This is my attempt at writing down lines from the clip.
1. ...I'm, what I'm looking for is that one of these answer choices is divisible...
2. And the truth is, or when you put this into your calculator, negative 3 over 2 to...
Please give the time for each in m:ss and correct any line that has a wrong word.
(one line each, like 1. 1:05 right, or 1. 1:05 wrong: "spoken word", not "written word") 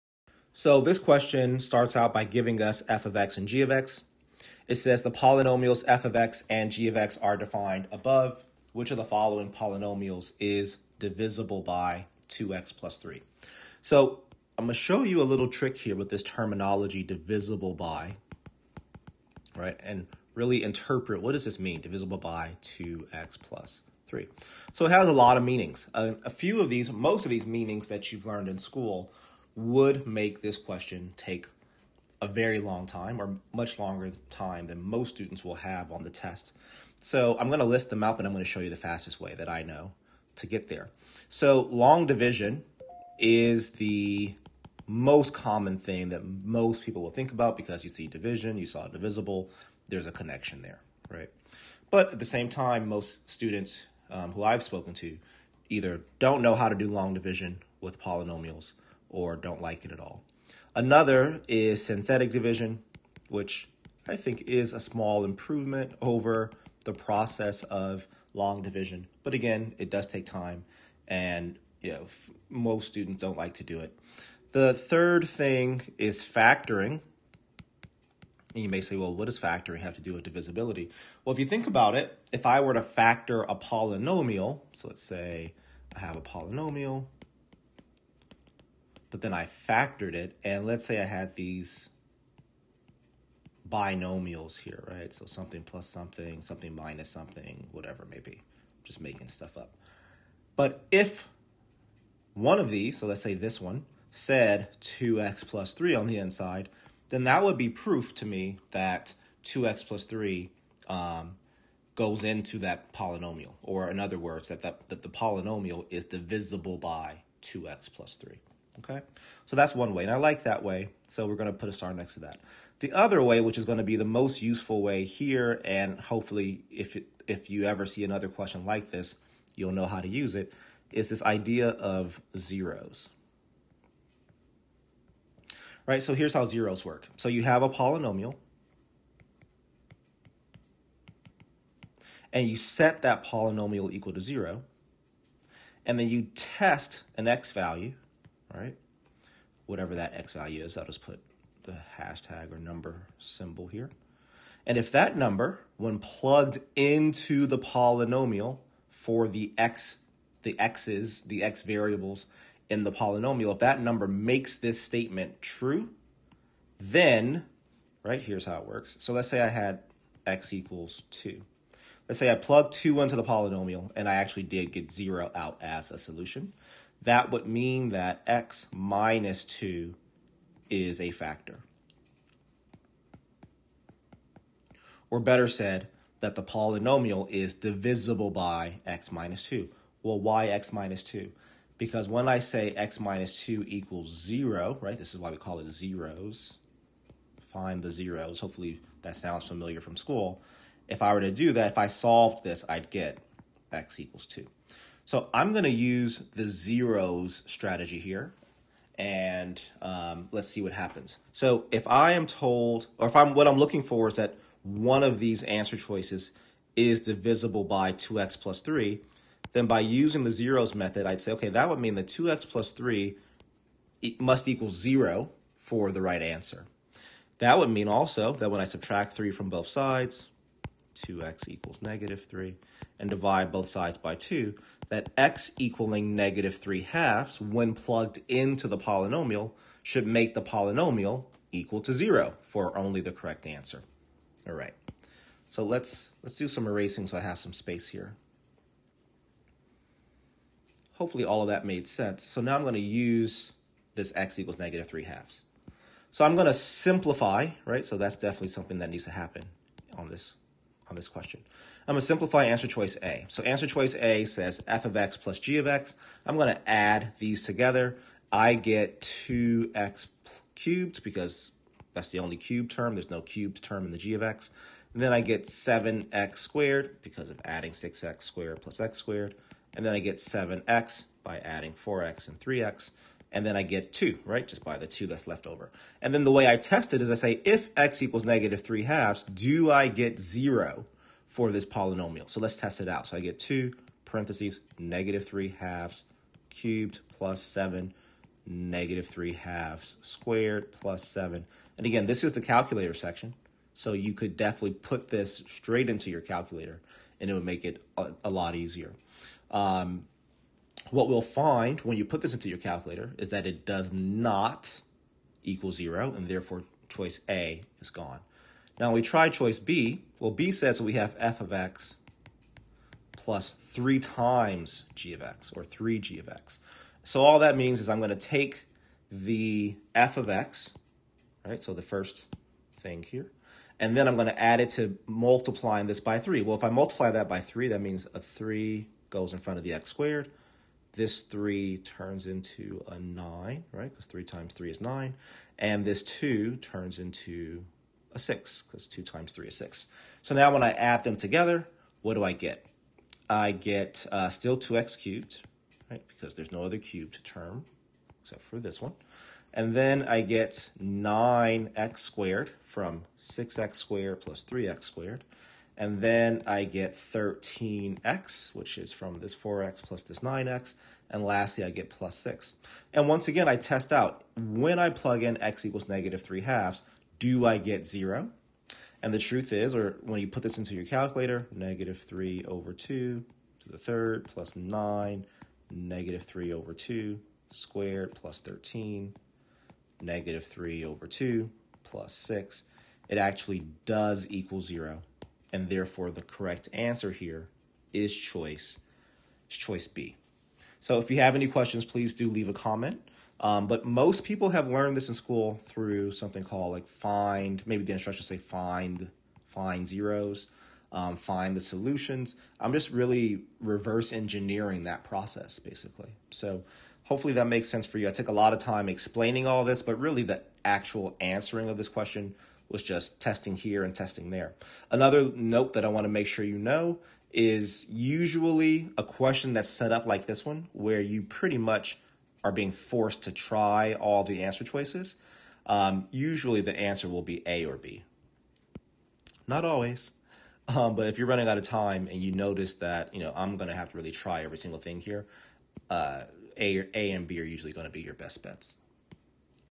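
1. 3:33 right
2. 6:19 right.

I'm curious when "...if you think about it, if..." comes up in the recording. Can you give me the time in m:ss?
1:21.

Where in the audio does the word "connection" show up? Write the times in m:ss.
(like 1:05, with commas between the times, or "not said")
0:50.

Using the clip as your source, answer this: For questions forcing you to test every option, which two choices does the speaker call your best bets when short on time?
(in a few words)
A and B.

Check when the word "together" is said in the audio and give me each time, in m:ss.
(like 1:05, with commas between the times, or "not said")
4:27, 5:51.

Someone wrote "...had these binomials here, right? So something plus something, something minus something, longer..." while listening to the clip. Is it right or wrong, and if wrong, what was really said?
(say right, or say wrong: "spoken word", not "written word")
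wrong: "whatever", not "longer".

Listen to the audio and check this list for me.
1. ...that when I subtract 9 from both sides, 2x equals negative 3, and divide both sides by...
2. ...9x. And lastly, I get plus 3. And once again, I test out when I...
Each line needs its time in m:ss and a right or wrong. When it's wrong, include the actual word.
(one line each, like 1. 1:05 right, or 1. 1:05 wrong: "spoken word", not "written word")
1. 3:48 wrong: "3", not "9"
2. 6:10 wrong: "6", not "3".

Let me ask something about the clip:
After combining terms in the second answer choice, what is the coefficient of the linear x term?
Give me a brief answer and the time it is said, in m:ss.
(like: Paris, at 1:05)
13, at 6:06.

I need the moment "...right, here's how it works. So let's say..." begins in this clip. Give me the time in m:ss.
2:48.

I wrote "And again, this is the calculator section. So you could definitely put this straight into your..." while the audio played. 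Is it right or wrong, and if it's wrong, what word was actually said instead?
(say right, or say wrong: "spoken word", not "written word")
right.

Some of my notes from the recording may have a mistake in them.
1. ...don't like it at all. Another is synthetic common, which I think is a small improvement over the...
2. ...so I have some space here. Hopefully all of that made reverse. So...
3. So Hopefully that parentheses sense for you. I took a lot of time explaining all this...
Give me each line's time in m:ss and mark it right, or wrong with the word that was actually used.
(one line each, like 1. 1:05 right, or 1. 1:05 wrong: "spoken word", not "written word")
1. 0:59 wrong: "division", not "common"
2. 4:07 wrong: "sense", not "reverse"
3. 6:56 wrong: "makes", not "parentheses".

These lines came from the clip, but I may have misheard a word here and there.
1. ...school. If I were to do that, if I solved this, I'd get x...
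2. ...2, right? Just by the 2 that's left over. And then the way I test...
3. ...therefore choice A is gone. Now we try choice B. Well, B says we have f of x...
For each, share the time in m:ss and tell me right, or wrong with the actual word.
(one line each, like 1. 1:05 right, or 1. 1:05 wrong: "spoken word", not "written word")
1. 3:19 right
2. 4:43 right
3. 5:16 right.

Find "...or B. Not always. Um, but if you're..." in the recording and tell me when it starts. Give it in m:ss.
7:17.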